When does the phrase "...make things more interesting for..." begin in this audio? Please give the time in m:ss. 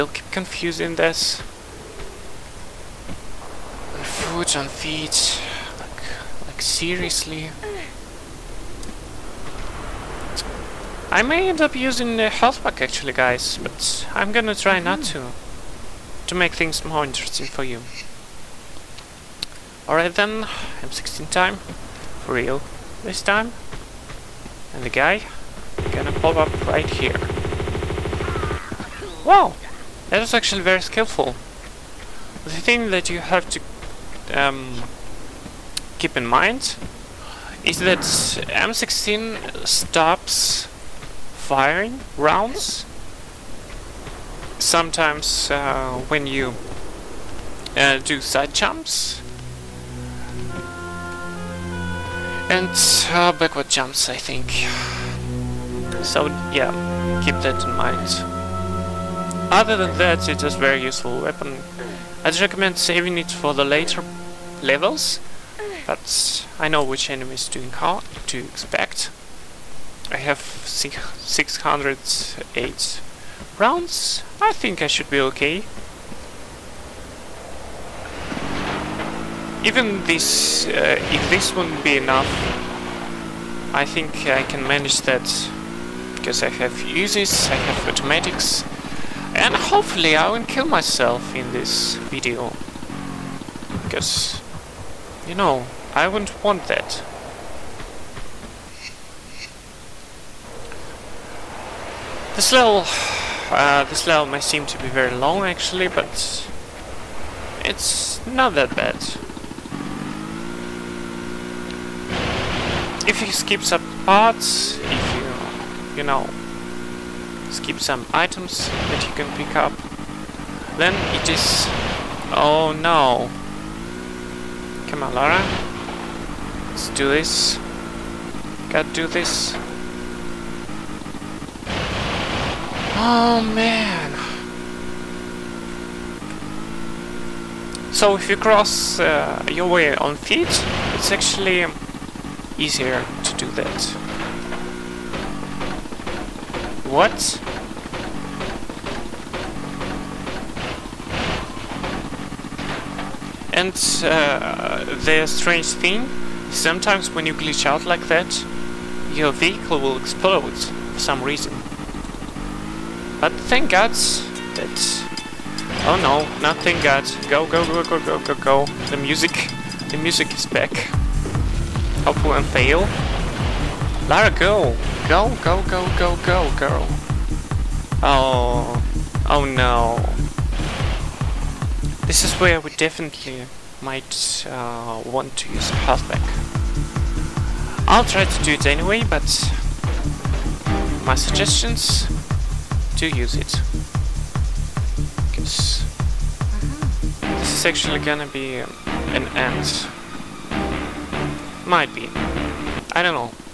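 0:16.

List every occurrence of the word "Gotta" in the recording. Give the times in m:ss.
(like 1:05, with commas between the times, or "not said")
2:08.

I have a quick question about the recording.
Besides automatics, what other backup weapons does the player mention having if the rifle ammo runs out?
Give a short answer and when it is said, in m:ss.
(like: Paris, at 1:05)
Uzis, at 1:26.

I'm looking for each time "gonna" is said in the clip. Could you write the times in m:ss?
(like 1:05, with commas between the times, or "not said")
0:14, 0:25, 3:17.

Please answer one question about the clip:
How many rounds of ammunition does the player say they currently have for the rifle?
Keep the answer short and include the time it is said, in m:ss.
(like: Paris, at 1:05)
608, at 1:10.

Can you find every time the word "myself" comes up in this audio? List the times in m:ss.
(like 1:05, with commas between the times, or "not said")
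1:30.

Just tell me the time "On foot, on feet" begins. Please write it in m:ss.
0:03.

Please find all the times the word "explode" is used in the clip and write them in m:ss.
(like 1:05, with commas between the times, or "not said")
2:39.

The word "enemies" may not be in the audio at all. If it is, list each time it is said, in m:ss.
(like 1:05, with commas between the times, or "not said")
1:07.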